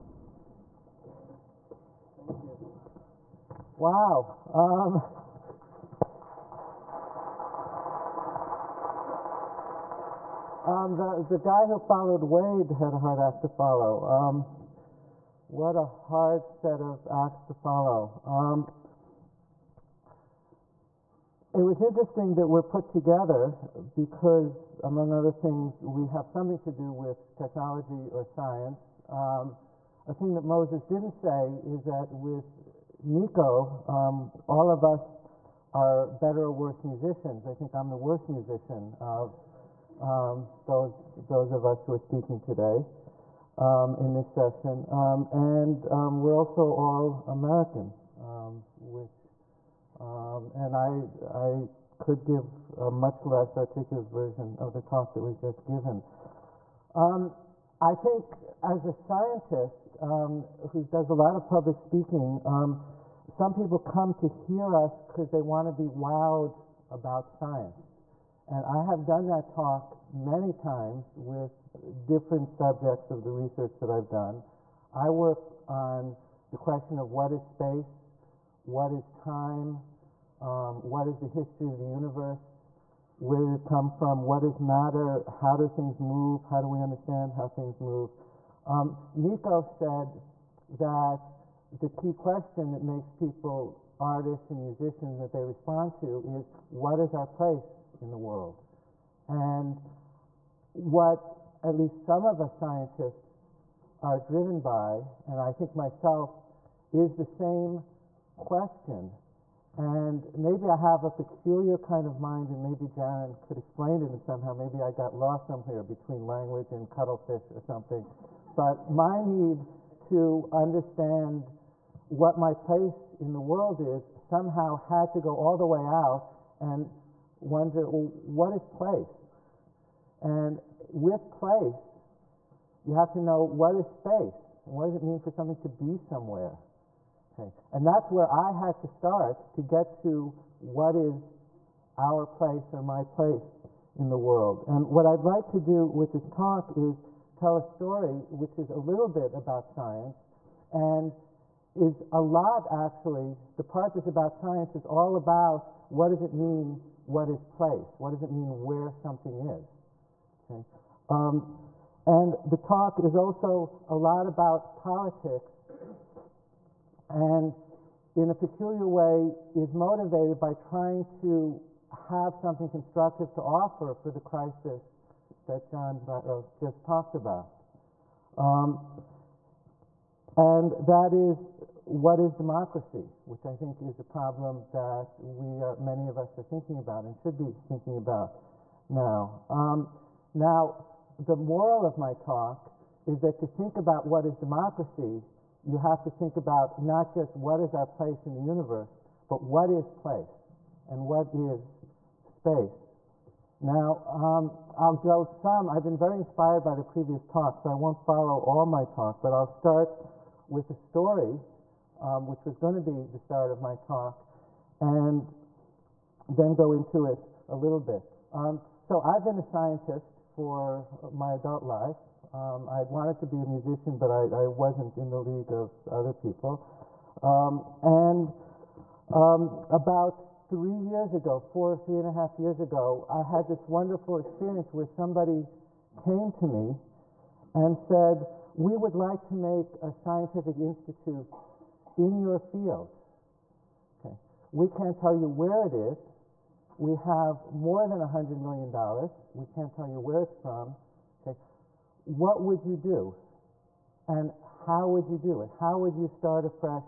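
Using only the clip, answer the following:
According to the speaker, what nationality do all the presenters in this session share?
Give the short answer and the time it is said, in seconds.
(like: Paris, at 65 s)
Americans, at 47 s.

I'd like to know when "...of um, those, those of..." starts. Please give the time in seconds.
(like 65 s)
38 s.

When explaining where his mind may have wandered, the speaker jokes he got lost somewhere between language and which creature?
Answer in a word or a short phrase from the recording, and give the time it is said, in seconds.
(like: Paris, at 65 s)
cuttlefish, at 116 s.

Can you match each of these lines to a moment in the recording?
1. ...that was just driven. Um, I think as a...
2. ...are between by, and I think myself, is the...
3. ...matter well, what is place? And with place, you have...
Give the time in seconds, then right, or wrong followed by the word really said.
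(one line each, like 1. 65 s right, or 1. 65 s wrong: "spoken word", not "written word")
1. 55 s wrong: "given", not "driven"
2. 104 s wrong: "driven", not "between"
3. 127 s wrong: "wonder", not "matter".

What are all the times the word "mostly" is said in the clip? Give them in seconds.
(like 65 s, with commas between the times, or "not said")
not said.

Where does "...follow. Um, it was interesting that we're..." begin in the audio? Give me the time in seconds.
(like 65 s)
17 s.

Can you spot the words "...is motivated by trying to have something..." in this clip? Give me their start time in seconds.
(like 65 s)
169 s.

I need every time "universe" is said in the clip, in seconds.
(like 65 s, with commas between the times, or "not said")
81 s, 198 s.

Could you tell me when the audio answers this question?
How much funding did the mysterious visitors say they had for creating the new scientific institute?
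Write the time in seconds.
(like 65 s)
247 s.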